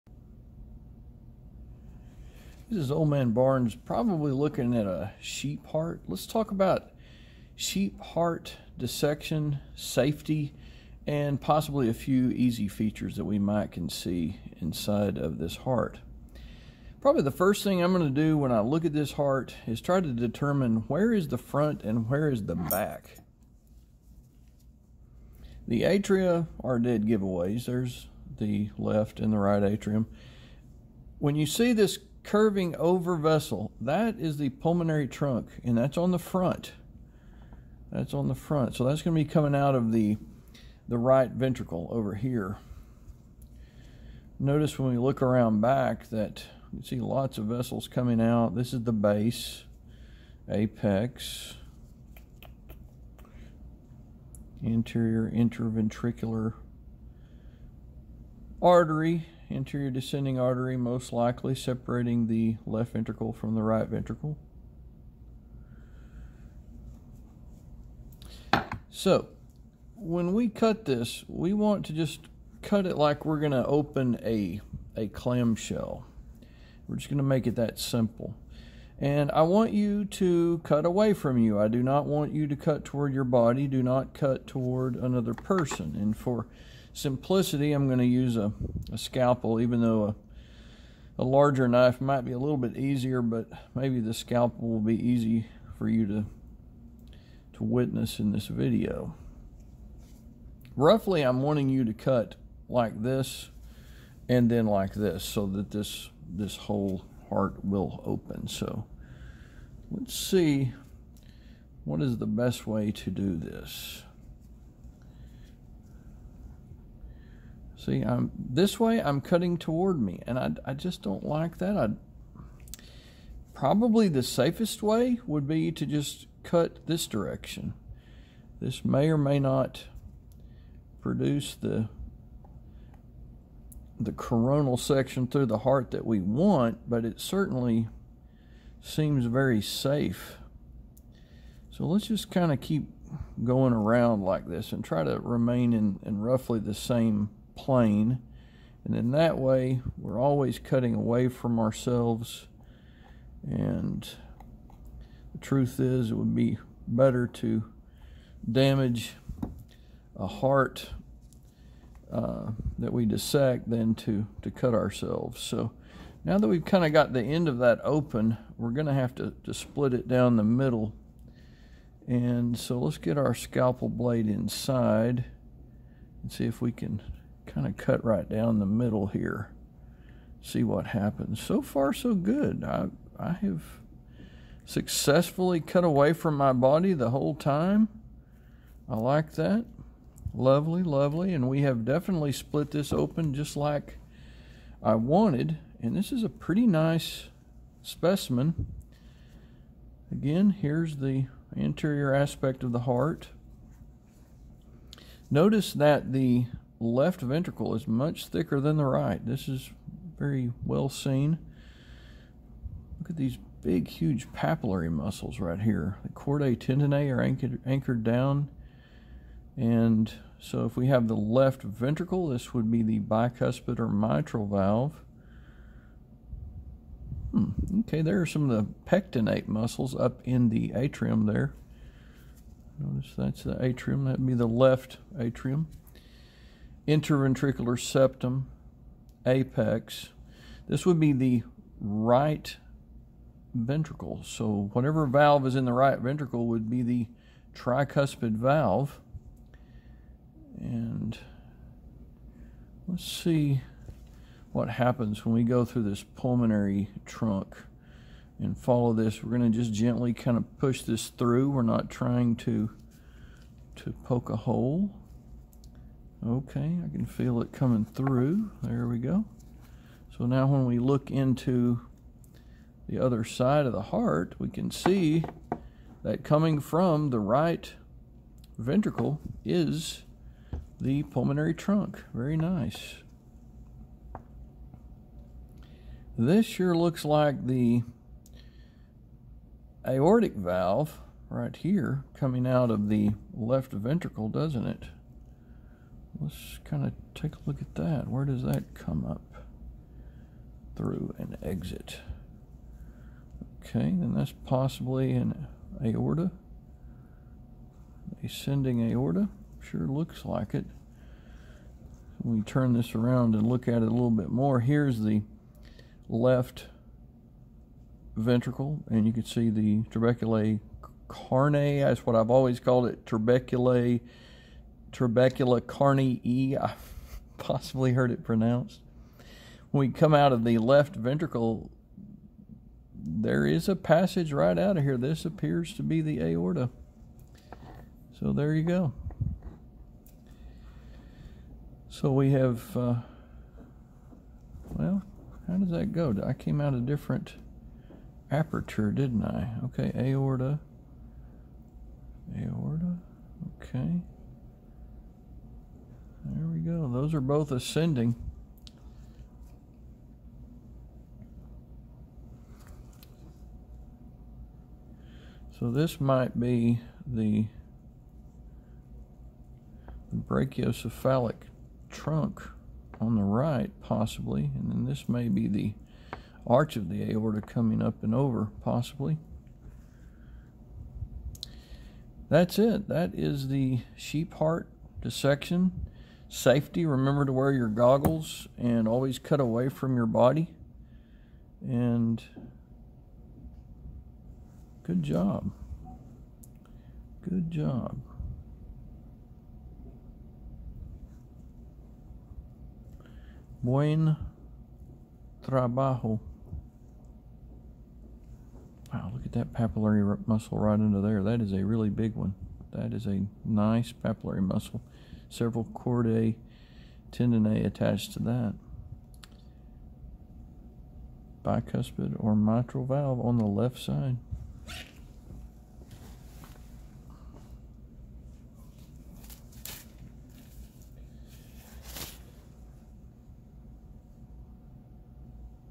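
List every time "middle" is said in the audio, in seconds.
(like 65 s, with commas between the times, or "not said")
170 s, 178 s.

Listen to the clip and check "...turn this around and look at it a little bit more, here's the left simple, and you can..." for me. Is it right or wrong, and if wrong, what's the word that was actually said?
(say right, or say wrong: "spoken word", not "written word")
wrong: "ventricle", not "simple".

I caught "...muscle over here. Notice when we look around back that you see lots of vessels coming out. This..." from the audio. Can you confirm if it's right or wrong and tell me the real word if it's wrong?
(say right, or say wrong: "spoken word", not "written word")
wrong: "ventricle", not "muscle".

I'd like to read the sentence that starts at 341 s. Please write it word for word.
So we have, uh, well, how does that go?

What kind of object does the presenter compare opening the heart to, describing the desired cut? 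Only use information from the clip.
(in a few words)
A clamshell.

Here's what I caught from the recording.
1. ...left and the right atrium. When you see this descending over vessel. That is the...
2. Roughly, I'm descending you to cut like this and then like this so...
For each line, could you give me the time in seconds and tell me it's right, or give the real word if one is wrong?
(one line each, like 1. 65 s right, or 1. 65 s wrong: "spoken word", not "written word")
1. 28 s wrong: "curving", not "descending"
2. 100 s wrong: "wanting", not "descending".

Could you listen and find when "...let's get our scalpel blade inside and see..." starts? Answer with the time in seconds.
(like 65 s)
172 s.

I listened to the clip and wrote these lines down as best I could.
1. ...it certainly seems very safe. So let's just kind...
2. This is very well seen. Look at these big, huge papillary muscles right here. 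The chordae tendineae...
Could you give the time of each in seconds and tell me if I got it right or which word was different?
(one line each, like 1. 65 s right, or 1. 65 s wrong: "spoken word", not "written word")
1. 137 s right
2. 209 s right.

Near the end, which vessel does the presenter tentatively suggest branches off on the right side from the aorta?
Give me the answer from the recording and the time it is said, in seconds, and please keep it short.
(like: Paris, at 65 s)
Brachiocephalic trunk, at 370 s.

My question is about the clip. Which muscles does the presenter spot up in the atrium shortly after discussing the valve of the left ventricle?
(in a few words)
Pectinate muscles.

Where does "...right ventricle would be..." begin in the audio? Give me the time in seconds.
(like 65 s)
245 s.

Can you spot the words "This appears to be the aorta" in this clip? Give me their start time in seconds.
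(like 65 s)
334 s.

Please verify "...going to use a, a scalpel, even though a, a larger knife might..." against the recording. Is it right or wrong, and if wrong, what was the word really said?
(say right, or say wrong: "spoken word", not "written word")
right.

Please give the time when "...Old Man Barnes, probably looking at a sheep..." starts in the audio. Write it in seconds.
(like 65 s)
2 s.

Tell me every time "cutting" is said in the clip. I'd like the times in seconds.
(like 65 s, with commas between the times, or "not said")
119 s, 150 s.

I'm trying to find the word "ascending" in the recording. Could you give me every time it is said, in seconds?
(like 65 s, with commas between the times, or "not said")
308 s, 357 s.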